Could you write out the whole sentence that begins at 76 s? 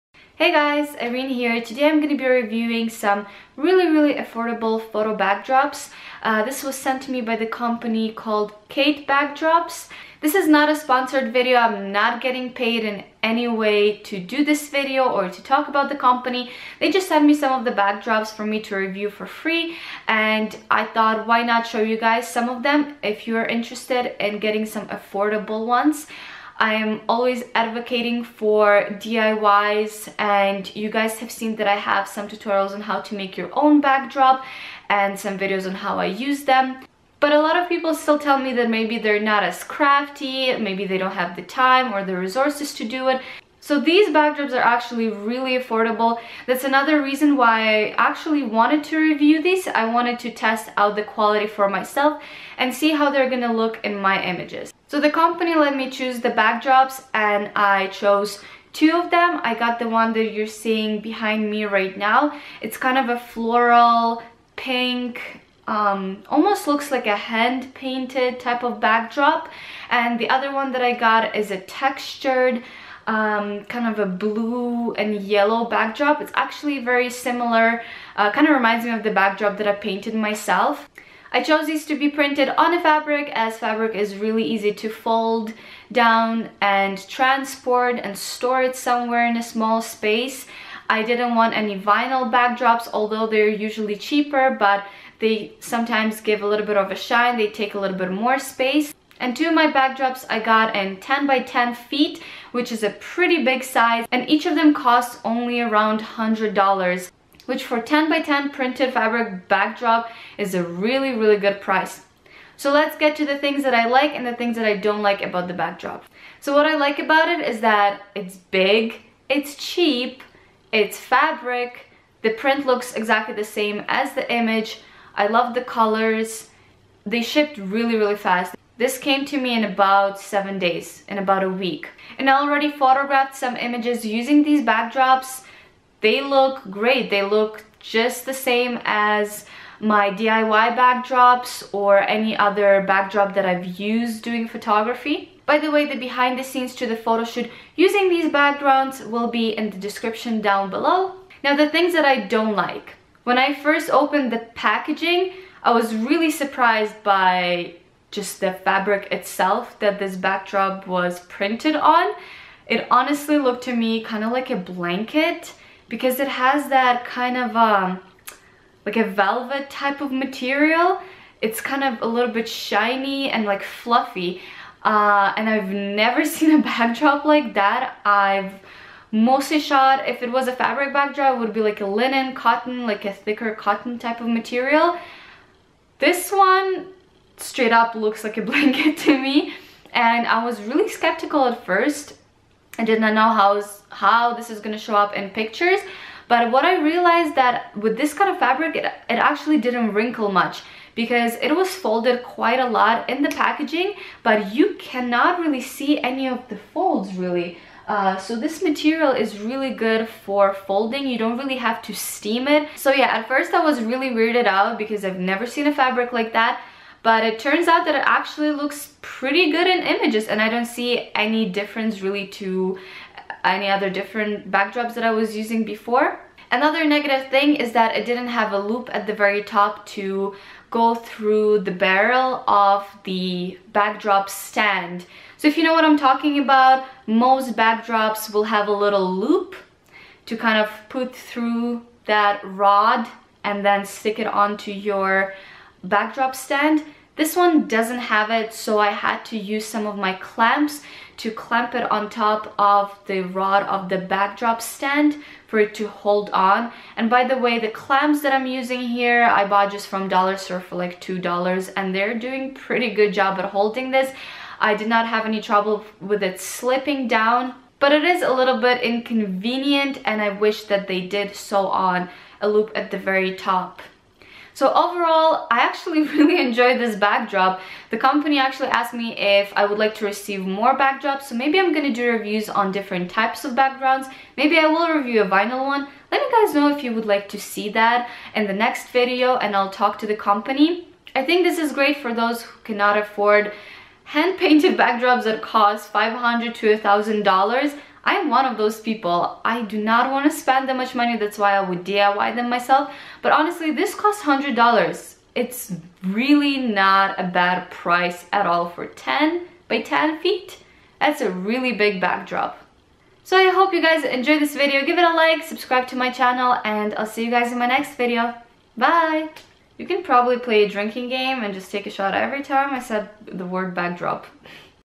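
It's actually very similar, uh, kind of reminds me of the backdrop that I painted myself.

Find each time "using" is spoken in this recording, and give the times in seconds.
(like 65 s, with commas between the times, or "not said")
134 s, 147 s, 225 s, 258 s.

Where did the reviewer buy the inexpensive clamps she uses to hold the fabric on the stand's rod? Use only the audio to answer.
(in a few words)
Dollar Store.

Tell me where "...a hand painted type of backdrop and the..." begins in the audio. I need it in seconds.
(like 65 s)
67 s.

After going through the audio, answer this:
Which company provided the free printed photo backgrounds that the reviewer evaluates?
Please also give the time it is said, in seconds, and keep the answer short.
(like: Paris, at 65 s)
Kate Backdrops, at 8 s.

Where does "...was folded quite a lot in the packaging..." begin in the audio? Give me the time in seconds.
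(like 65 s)
201 s.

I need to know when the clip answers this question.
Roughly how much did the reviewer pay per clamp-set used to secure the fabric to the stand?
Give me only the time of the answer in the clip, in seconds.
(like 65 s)
261 s.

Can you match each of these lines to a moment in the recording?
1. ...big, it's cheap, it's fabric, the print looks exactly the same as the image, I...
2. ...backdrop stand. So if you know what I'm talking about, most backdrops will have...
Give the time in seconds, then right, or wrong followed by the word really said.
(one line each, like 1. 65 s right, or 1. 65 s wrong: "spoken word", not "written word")
1. 118 s right
2. 233 s right.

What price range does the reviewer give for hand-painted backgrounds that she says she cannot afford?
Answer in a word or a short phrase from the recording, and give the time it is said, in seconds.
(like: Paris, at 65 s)
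$500 to $1,000, at 295 s.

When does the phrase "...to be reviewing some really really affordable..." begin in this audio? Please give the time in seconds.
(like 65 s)
2 s.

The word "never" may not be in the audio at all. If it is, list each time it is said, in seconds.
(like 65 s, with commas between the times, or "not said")
175 s, 215 s.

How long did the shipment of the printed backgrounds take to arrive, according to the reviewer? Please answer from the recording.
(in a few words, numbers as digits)
7 days.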